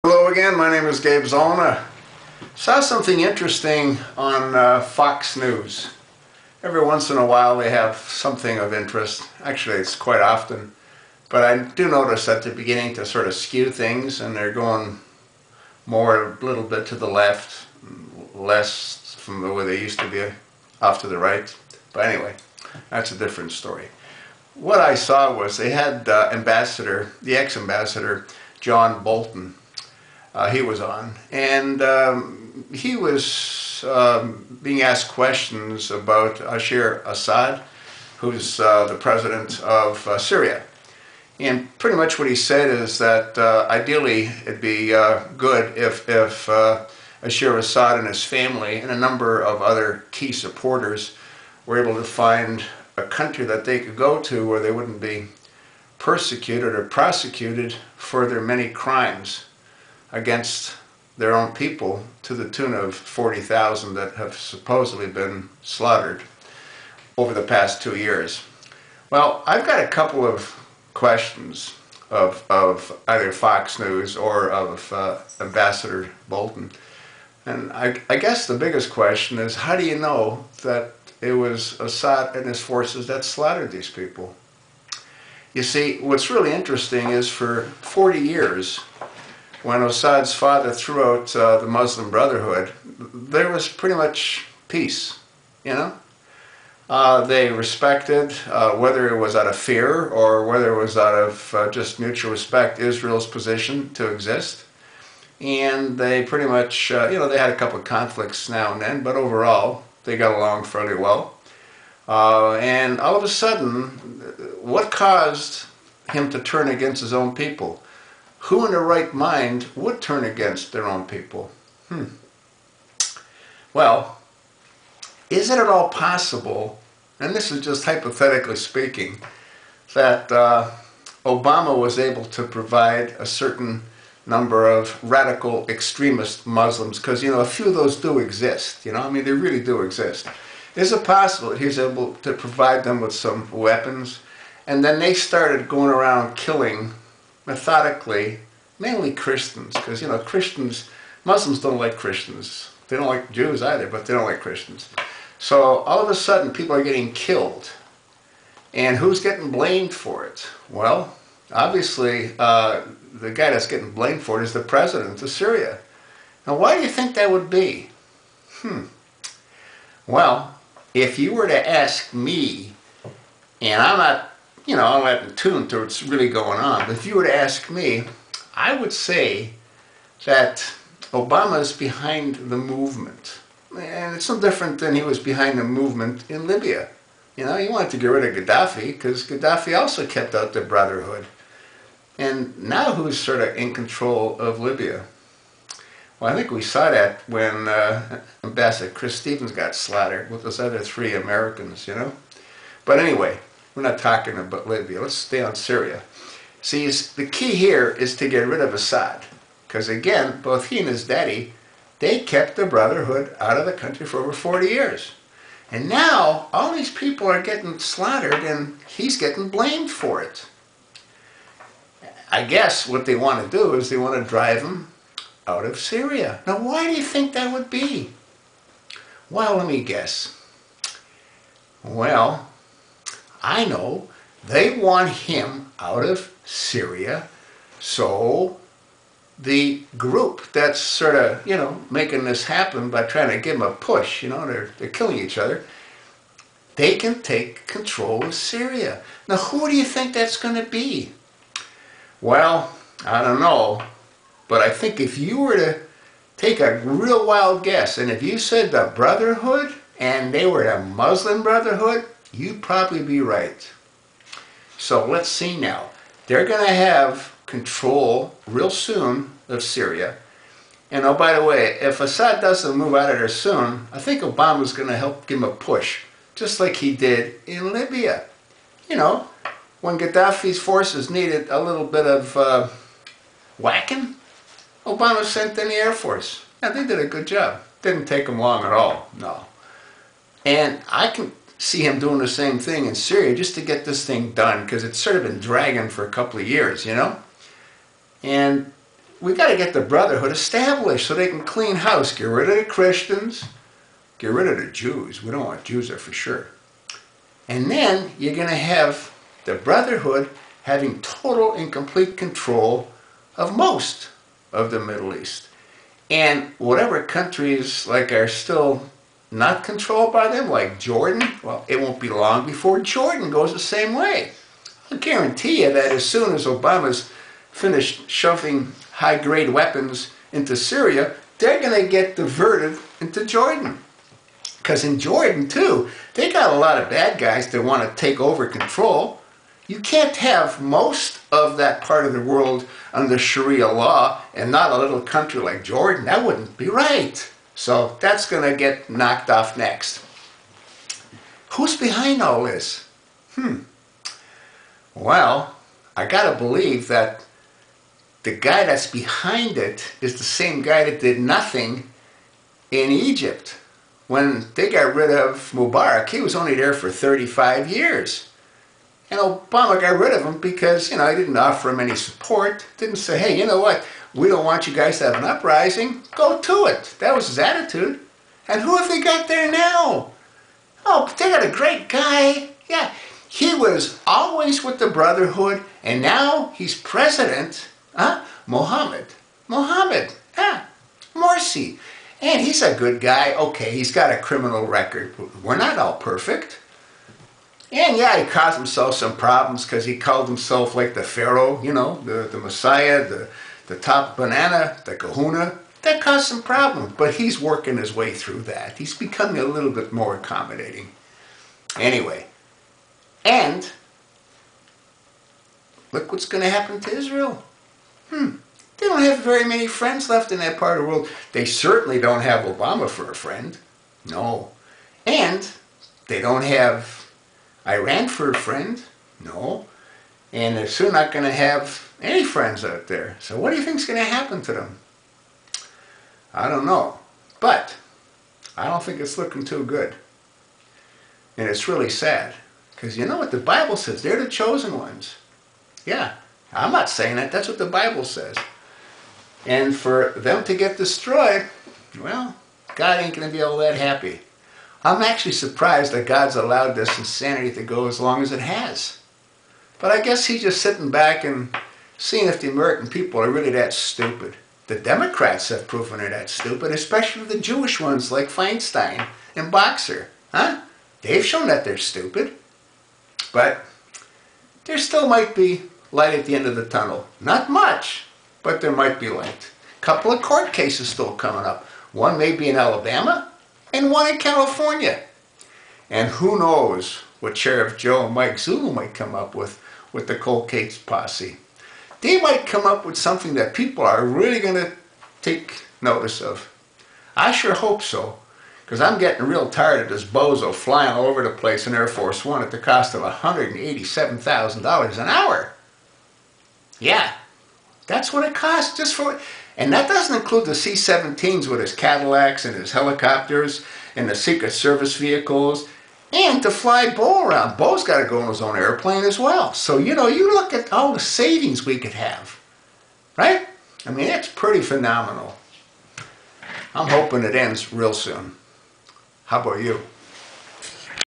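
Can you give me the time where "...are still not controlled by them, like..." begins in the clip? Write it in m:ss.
5:18.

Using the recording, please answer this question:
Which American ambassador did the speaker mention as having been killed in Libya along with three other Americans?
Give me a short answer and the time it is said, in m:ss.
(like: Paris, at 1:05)
Chris Stevens, at 3:18.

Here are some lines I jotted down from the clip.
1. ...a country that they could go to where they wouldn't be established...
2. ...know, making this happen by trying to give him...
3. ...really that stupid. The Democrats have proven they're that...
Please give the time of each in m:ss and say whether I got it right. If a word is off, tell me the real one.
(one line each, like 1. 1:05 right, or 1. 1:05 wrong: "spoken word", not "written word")
1. 0:52 wrong: "persecuted", not "established"
2. 4:01 right
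3. 7:43 right.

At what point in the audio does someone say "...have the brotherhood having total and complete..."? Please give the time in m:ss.
5:08.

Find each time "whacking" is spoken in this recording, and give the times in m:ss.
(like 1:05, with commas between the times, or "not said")
4:43.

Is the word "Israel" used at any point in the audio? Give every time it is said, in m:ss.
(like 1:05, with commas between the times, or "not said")
1:42, 6:56.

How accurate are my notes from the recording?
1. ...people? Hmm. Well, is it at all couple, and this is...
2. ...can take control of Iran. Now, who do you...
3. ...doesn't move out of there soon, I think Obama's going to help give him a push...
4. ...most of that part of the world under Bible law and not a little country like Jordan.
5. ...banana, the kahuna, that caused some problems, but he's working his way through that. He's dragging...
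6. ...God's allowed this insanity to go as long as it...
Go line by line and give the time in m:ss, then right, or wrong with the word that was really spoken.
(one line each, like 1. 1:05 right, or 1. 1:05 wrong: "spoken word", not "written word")
1. 2:01 wrong: "possible", not "couple"
2. 4:06 wrong: "Syria", not "Iran"
3. 4:32 right
4. 5:40 wrong: "Sharia", not "Bible"
5. 6:44 wrong: "becoming", not "dragging"
6. 7:36 right.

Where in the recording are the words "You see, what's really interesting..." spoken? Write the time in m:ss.
1:25.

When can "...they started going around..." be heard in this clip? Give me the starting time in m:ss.
2:24.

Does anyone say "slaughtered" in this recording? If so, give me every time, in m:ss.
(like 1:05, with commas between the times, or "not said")
1:05, 1:23, 3:19, 3:37.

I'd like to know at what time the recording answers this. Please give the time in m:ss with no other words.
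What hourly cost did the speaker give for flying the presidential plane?
8:23.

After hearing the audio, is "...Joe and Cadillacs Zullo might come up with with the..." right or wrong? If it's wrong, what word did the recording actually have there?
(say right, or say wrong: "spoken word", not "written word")
wrong: "Mike", not "Cadillacs".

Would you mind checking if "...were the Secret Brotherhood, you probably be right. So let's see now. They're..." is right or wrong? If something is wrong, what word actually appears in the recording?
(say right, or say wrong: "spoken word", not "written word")
wrong: "Muslim", not "Secret".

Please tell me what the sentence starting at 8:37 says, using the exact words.
Bo's got to go on his own airplane as well.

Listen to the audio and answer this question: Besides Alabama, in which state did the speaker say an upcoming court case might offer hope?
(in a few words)
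California.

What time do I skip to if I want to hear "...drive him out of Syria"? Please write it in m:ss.
3:44.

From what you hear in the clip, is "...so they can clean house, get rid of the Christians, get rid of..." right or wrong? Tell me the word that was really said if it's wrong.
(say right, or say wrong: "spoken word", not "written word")
right.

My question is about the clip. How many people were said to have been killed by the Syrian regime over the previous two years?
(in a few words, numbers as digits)
40,000.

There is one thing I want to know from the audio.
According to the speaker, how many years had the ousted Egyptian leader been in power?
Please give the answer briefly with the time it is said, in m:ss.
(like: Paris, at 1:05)
35 years, at 6:06.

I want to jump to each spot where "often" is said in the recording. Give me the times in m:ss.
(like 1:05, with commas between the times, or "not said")
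0:10.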